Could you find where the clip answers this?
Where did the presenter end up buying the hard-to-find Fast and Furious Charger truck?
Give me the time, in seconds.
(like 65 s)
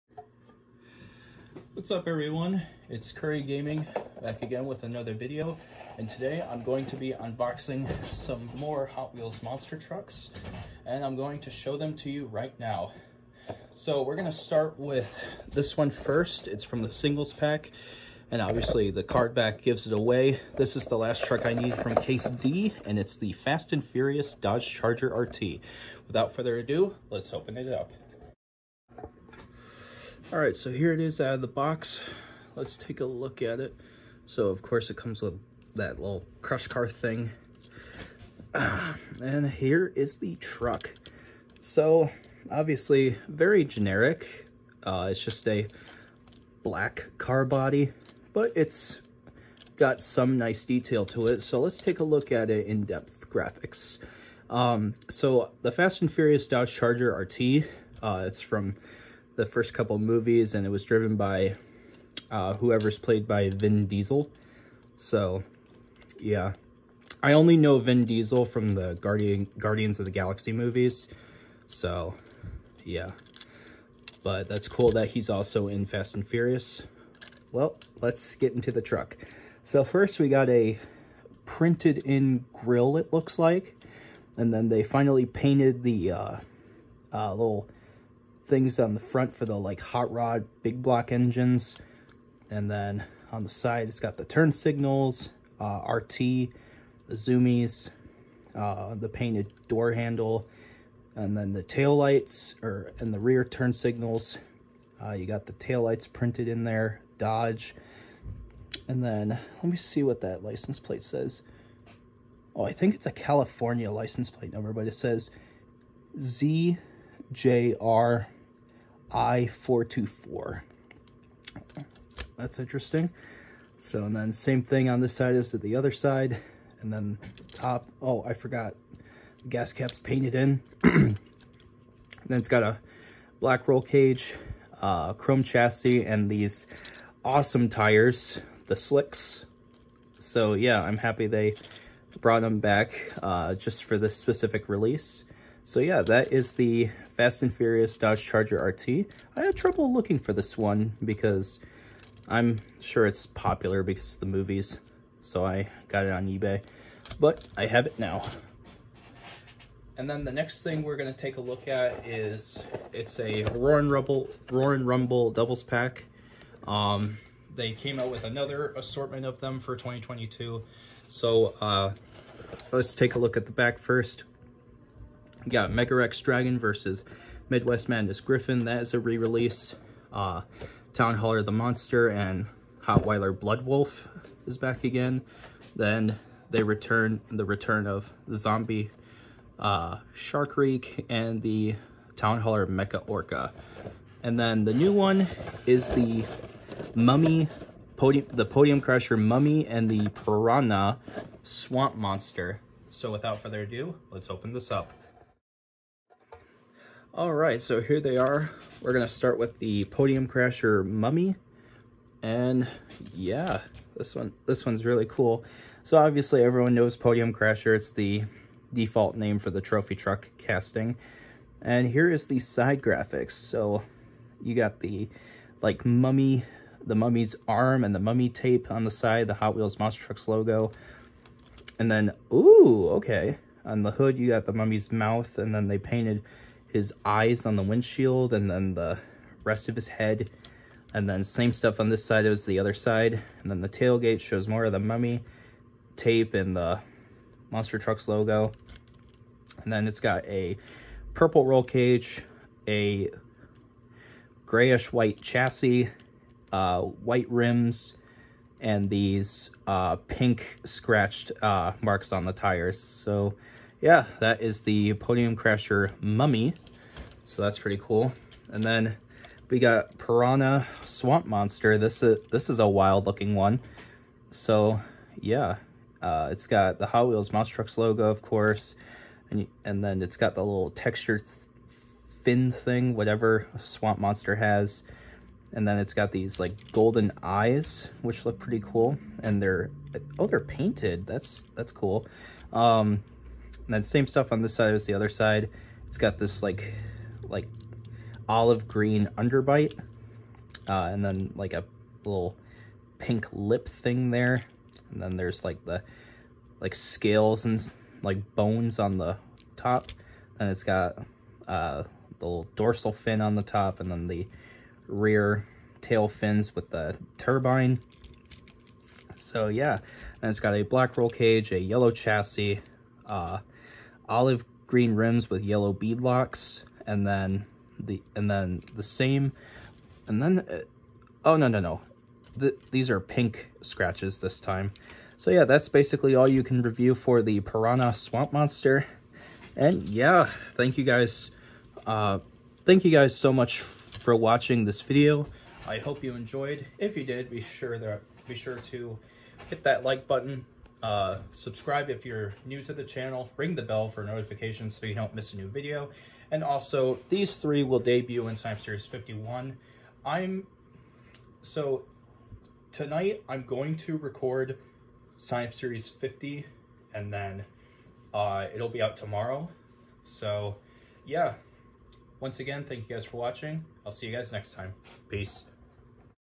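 156 s.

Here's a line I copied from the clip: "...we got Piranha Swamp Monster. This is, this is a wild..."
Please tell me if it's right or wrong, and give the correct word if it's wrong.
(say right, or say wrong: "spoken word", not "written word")
right.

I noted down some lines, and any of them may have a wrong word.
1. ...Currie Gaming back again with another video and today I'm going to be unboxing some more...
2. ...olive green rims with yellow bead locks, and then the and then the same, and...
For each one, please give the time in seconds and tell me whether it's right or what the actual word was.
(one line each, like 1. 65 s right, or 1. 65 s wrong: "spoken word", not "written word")
1. 3 s right
2. 324 s right.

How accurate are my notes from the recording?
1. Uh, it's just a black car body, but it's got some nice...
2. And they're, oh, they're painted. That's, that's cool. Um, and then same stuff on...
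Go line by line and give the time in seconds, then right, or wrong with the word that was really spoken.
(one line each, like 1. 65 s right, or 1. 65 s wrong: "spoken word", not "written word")
1. 44 s right
2. 289 s right.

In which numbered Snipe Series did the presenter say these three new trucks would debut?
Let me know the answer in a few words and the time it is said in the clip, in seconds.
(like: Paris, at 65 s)
Snipe Series 51, at 358 s.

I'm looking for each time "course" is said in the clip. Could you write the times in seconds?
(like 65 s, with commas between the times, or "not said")
34 s, 278 s.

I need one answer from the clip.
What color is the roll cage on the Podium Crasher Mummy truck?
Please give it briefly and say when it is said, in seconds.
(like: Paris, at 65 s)
Purple, at 251 s.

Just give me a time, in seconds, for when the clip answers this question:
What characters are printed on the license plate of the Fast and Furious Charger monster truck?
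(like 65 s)
116 s.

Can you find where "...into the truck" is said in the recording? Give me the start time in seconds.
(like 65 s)
78 s.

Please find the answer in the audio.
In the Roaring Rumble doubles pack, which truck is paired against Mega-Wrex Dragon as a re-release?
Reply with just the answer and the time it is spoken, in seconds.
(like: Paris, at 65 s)
Midwest Madness Griffin, at 177 s.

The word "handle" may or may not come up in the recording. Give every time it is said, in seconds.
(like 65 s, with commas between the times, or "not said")
99 s.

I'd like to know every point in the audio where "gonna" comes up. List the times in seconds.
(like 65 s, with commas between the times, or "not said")
160 s, 208 s.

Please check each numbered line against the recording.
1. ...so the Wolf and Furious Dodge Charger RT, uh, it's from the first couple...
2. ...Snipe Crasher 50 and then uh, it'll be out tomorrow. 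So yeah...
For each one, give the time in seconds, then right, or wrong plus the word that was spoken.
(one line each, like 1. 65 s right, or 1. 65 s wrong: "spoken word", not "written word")
1. 55 s wrong: "Fast", not "Wolf"
2. 365 s wrong: "Series", not "Crasher".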